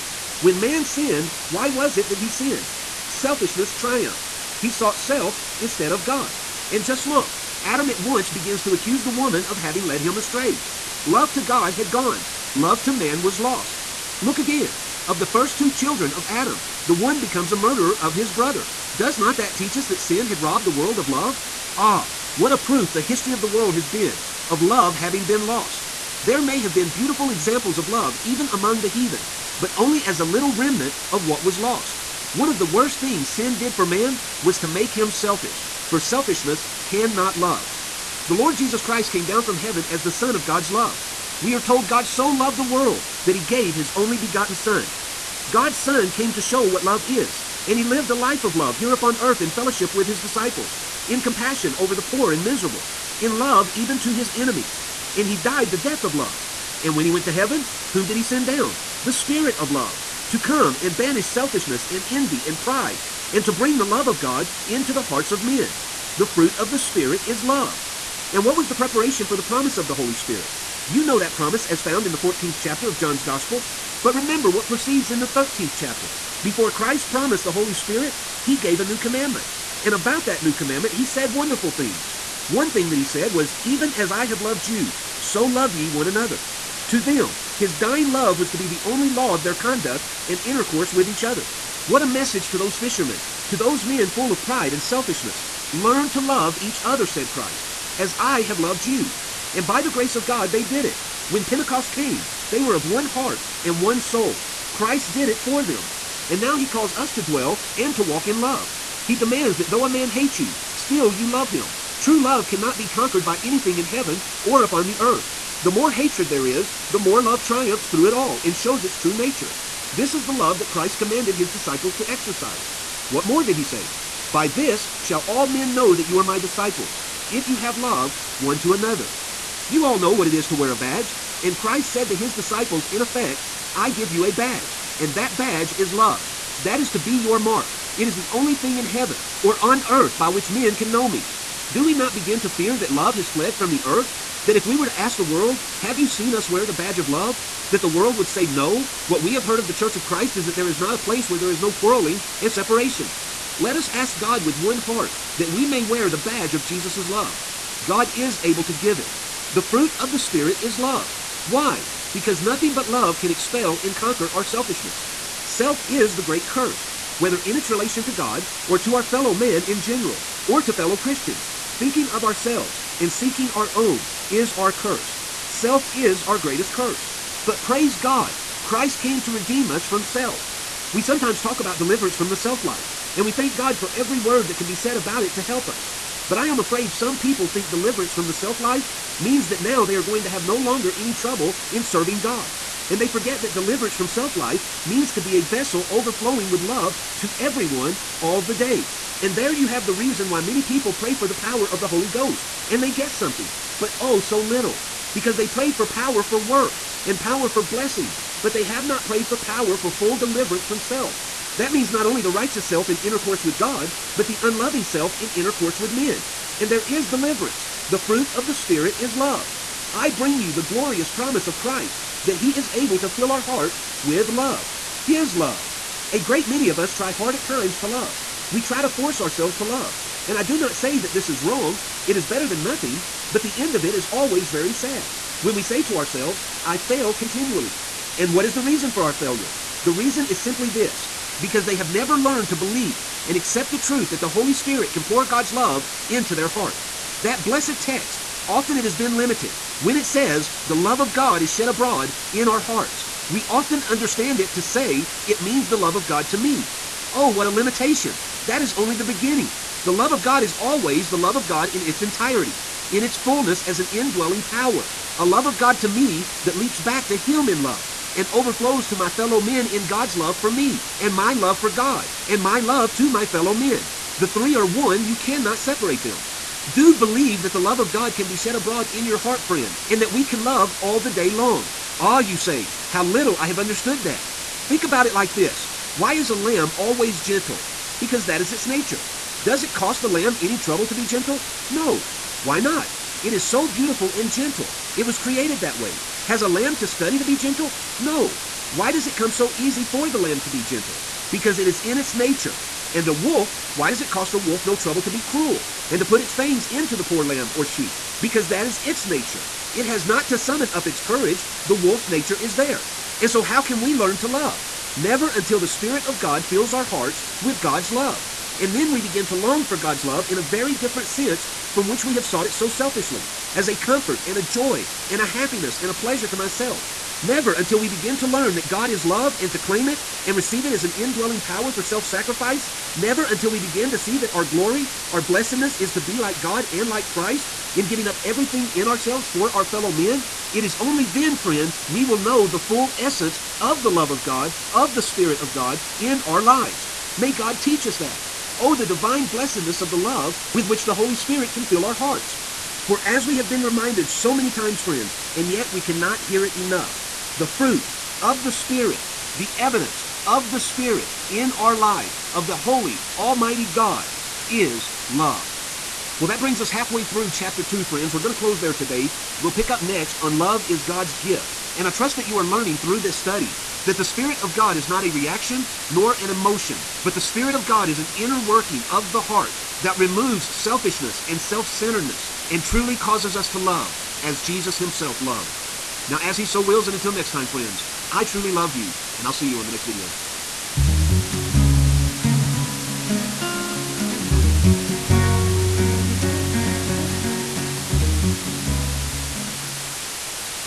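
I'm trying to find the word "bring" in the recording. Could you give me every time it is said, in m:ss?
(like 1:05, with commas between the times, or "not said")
1:03, 3:40, 6:06.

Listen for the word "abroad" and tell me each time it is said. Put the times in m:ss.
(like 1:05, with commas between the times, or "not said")
4:11, 4:38.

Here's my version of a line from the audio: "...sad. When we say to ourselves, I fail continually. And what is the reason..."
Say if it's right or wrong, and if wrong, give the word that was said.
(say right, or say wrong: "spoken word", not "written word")
right.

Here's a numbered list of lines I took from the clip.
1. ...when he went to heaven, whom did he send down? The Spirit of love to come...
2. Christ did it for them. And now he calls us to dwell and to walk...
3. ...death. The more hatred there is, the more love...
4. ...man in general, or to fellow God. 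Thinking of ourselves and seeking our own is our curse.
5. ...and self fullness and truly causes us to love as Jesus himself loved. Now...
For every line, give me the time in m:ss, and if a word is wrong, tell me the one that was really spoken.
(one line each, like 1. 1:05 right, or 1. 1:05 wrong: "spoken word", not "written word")
1. 0:56 right
2. 1:44 right
3. 1:54 wrong: "earth", not "death"
4. 2:49 wrong: "Christians", not "God"
5. 6:21 wrong: "centeredness", not "fullness".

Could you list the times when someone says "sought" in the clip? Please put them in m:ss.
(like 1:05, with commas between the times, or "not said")
0:04, 5:22.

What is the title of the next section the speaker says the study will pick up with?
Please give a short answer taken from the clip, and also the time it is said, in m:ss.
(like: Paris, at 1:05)
Love is God's Gift, at 6:10.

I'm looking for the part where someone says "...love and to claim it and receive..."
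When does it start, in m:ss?
5:29.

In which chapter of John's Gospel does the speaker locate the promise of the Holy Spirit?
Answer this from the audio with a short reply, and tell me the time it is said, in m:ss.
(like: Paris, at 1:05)
14th chapter, at 1:12.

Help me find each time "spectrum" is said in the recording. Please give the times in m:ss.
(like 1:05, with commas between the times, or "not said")
not said.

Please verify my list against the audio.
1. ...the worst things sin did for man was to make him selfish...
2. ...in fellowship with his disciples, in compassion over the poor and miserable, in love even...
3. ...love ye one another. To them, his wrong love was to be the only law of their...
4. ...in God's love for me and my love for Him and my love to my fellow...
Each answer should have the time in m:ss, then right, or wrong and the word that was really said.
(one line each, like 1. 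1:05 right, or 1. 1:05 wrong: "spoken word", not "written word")
1. 0:32 right
2. 0:49 right
3. 1:25 wrong: "dying", not "wrong"
4. 4:29 wrong: "God", not "Him".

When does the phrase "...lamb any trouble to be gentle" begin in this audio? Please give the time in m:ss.
4:50.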